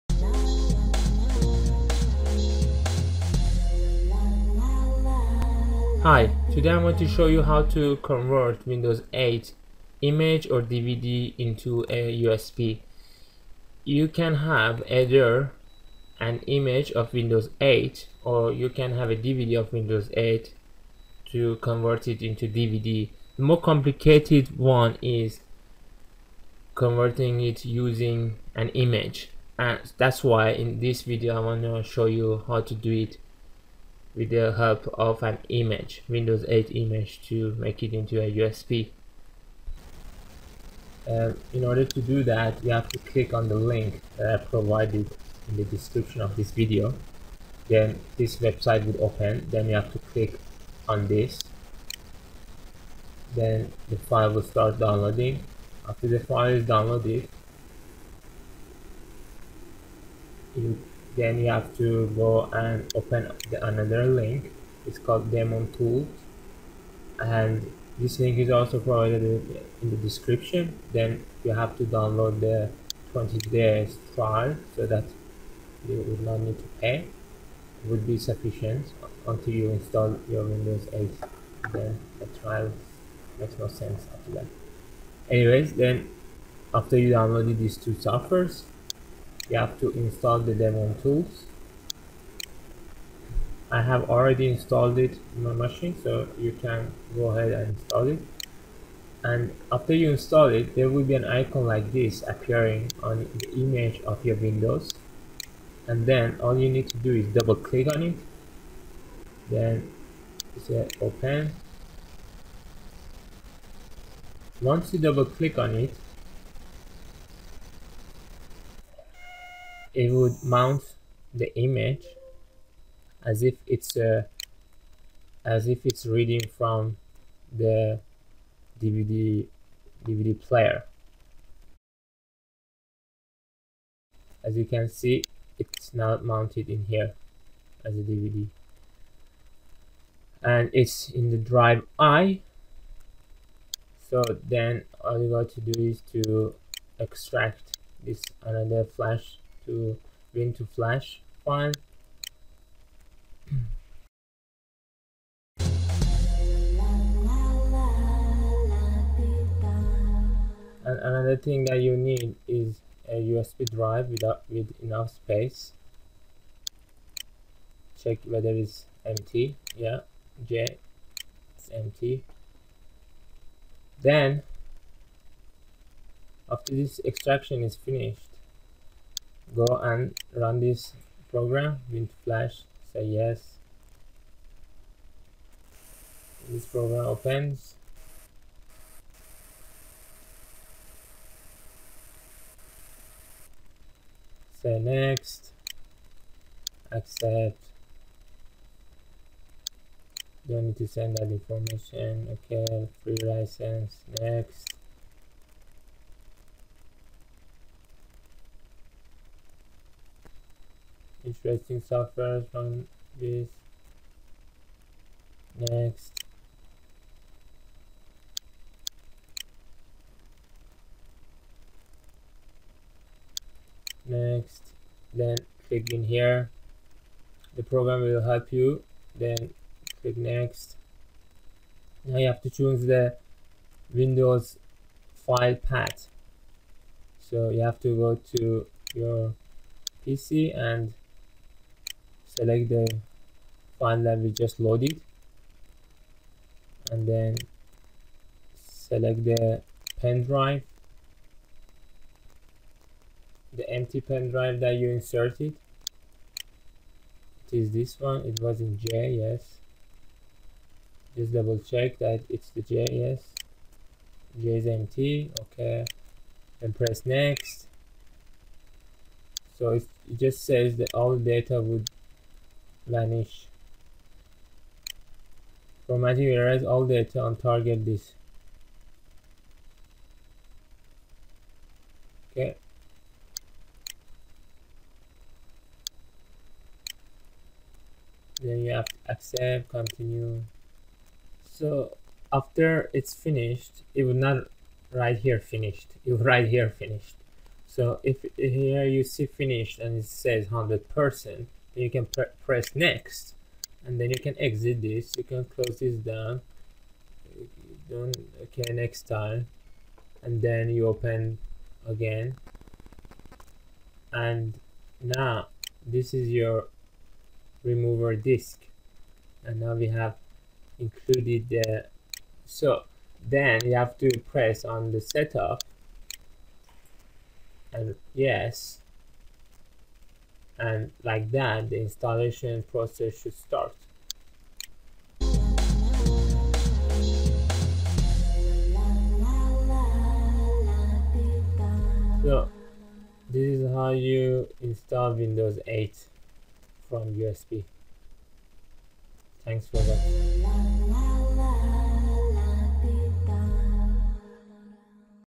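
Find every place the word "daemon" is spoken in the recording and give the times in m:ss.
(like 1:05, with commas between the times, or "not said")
1:05, 1:30.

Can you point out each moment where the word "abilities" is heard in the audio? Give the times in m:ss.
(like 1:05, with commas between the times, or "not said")
not said.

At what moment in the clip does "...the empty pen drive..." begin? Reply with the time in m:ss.
4:13.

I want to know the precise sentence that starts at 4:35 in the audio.
From Erase, all data on target disk.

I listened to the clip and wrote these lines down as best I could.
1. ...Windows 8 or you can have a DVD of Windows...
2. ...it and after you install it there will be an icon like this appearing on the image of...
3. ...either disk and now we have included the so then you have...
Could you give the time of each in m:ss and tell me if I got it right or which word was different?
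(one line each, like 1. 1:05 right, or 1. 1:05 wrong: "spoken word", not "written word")
1. 0:17 right
2. 1:38 right
3. 5:17 wrong: "remover", not "either".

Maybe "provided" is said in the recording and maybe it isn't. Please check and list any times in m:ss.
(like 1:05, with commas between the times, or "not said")
0:44, 1:08.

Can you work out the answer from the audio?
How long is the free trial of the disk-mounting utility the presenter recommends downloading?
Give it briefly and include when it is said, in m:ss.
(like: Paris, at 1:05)
20 days, at 1:13.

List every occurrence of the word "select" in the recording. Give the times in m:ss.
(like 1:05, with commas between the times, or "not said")
4:02, 4:08.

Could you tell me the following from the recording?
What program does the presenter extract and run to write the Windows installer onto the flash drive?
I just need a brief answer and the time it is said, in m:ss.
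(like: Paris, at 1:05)
WinToFlash, at 2:30.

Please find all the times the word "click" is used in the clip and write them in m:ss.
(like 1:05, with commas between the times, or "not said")
0:42, 0:49, 1:47, 1:55, 3:45, 3:50.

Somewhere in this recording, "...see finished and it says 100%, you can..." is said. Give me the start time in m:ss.
4:59.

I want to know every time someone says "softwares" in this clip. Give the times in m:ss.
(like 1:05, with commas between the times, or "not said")
1:27, 3:31.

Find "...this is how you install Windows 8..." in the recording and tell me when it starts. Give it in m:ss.
5:43.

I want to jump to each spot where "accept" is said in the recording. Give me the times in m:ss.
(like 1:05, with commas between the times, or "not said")
3:16, 4:49.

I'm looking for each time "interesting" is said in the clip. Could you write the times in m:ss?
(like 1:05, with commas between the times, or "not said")
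3:31.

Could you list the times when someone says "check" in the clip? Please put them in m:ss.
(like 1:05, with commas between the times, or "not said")
2:48, 4:21.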